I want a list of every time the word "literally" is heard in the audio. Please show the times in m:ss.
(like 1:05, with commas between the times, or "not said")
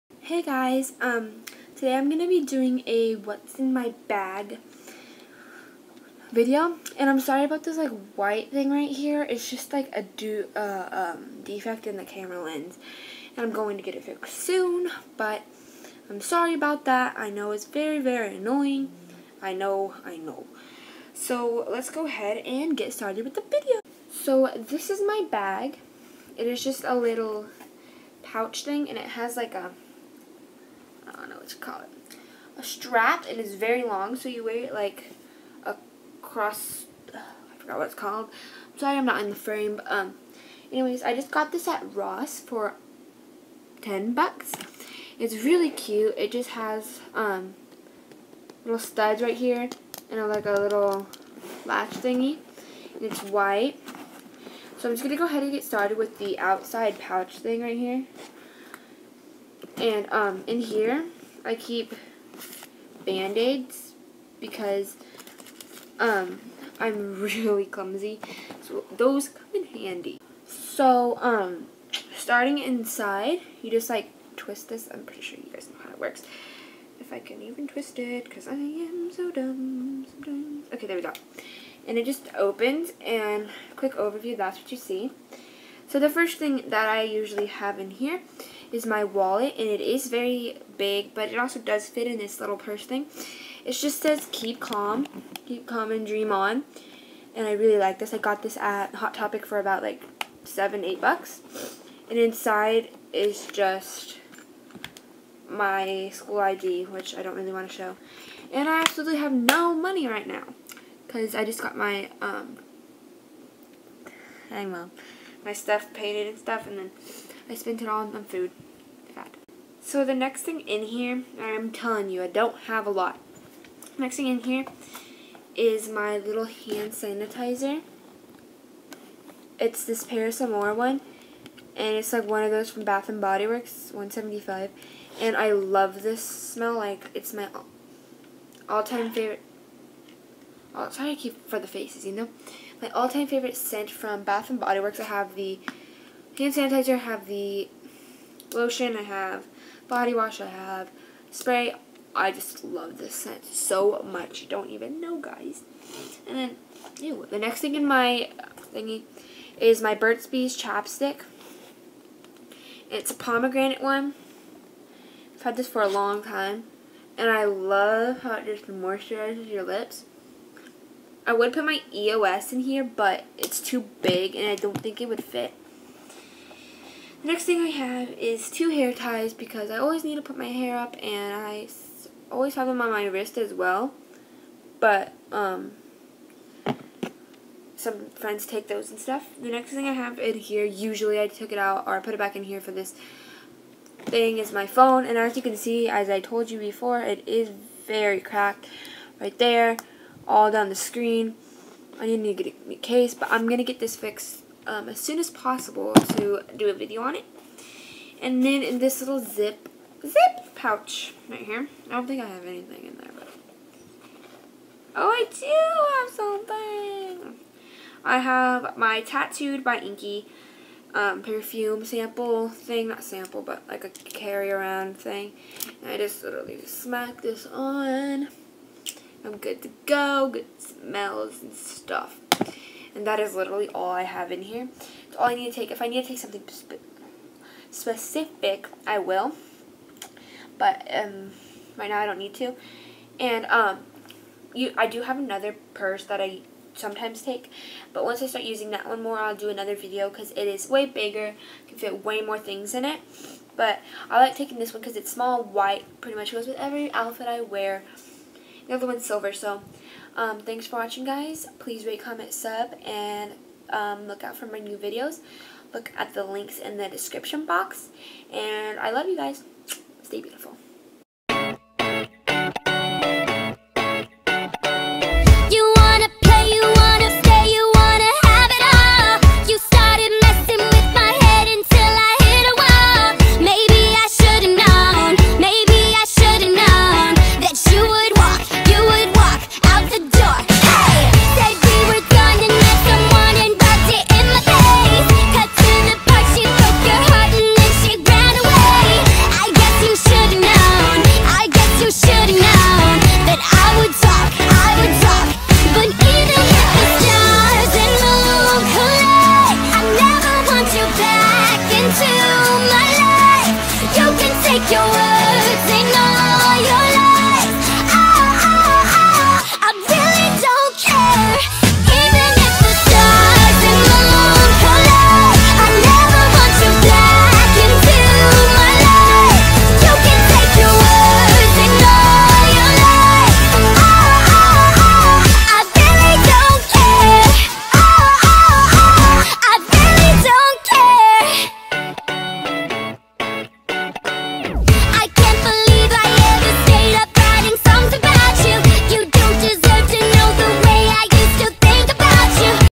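3:46, 3:53.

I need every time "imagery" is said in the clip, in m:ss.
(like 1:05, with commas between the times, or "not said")
not said.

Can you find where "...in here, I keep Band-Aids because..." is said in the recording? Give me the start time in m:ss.
1:00.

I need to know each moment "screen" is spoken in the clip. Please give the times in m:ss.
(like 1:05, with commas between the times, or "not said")
3:20.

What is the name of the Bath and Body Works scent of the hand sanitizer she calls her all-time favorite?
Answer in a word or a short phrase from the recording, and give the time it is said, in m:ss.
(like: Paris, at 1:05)
Paris Amour, at 2:10.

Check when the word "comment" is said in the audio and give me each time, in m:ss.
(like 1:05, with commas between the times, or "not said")
4:21.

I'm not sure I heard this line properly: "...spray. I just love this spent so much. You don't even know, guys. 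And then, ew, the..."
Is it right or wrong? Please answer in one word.
wrong.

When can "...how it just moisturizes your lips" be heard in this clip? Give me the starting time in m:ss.
2:48.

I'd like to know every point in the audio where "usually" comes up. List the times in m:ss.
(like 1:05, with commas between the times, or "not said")
1:27, 3:10.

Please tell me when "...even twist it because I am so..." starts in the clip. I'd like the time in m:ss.
1:17.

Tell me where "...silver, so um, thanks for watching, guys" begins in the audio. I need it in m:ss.
4:19.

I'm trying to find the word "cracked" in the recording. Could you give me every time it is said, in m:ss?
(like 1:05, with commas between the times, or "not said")
3:18.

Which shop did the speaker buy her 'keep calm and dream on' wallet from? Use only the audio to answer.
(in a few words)
Hot Topic.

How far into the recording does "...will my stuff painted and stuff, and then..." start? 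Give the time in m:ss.
1:54.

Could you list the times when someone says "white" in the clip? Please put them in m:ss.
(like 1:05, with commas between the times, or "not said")
0:08, 0:53, 4:15.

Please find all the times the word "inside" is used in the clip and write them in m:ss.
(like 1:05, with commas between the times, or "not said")
1:12, 1:42.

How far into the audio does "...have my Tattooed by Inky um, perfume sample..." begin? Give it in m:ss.
3:38.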